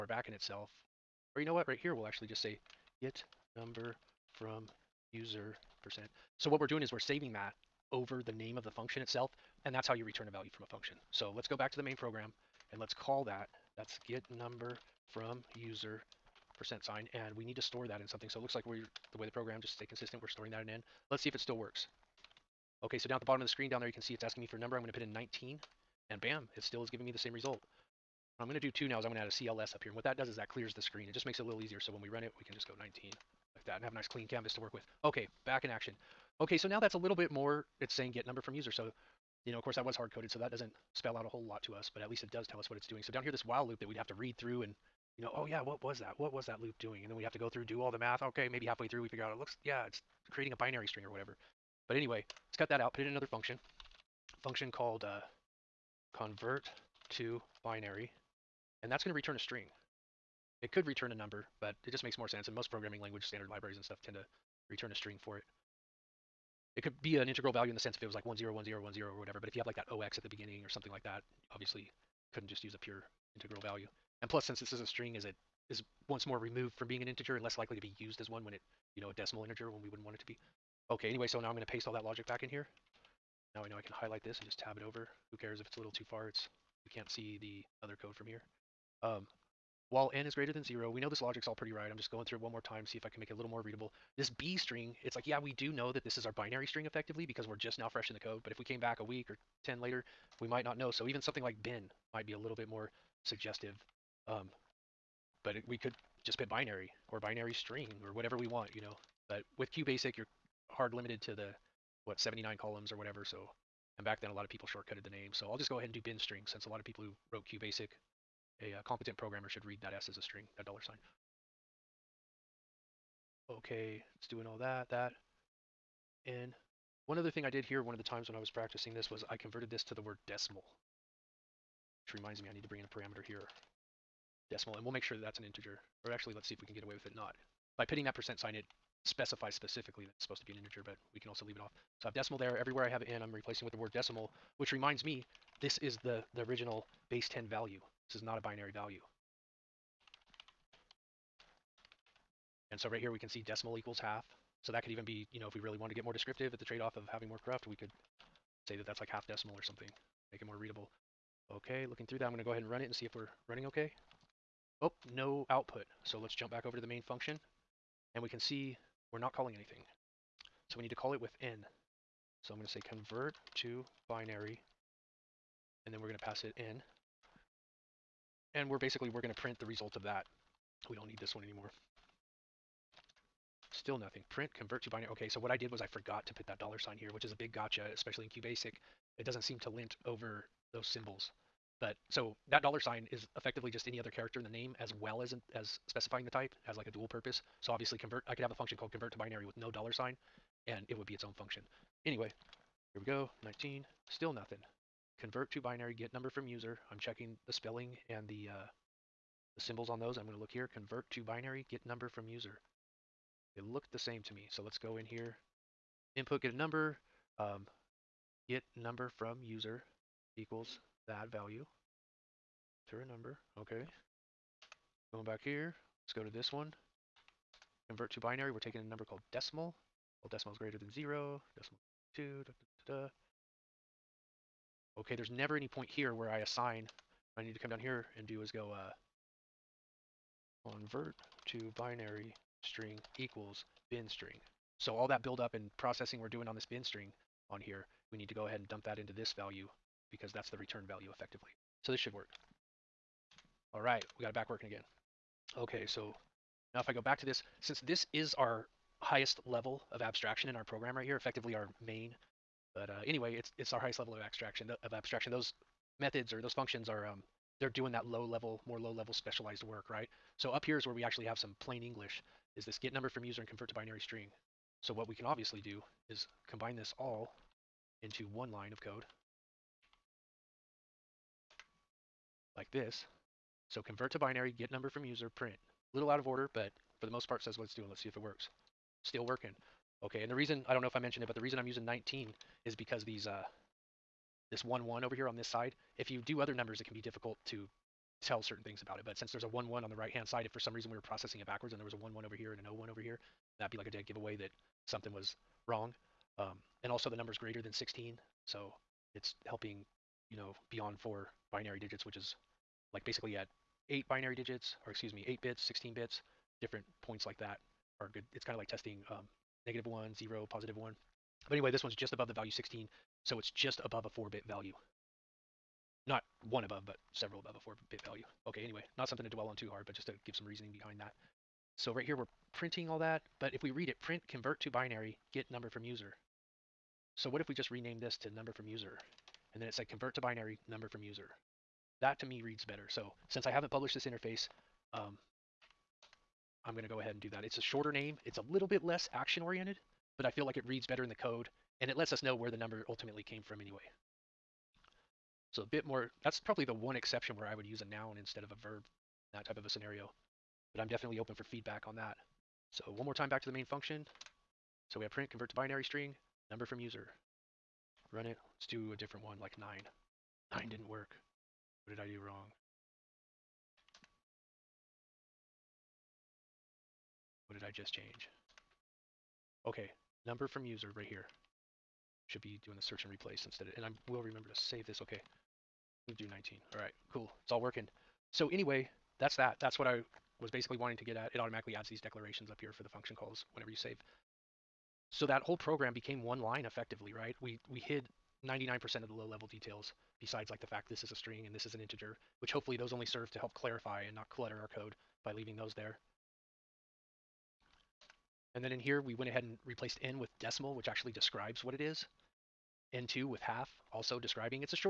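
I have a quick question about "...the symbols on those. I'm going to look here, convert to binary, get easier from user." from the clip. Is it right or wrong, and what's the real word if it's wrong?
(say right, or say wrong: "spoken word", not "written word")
wrong: "number", not "easier".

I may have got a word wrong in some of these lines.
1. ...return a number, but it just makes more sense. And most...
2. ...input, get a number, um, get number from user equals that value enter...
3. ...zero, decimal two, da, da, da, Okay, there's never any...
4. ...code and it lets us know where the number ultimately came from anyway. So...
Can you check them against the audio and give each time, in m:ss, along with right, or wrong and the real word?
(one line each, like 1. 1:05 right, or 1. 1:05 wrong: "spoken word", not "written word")
1. 1:00 right
2. 3:36 right
3. 3:50 right
4. 5:51 right.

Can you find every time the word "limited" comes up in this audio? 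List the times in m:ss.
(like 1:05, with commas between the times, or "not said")
1:50.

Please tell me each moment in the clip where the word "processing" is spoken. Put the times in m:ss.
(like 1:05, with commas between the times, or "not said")
4:05, 5:01.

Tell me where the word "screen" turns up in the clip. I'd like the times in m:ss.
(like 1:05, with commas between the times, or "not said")
0:23, 0:30.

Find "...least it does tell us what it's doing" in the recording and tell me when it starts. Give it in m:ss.
0:42.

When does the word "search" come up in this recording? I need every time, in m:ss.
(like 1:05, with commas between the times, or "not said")
6:22.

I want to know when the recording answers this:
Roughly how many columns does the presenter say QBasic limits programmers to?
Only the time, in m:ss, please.
1:52.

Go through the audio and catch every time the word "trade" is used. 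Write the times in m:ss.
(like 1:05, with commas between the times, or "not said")
2:36.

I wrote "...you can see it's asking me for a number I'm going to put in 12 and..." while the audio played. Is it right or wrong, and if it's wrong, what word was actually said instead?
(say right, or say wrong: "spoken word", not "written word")
wrong: "19", not "12".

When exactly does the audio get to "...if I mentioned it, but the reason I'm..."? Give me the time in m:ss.
4:50.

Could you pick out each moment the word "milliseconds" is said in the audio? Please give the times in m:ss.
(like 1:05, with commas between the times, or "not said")
not said.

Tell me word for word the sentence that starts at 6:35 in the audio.
So that whole program became one line effectively, right?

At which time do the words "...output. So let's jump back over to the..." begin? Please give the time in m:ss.
2:45.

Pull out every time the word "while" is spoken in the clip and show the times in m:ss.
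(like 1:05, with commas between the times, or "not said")
0:43, 1:29.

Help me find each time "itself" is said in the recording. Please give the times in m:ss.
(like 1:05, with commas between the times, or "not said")
0:00, 0:09.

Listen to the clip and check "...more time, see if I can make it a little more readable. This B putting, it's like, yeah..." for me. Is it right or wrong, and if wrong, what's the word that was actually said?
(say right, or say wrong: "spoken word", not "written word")
wrong: "string", not "putting".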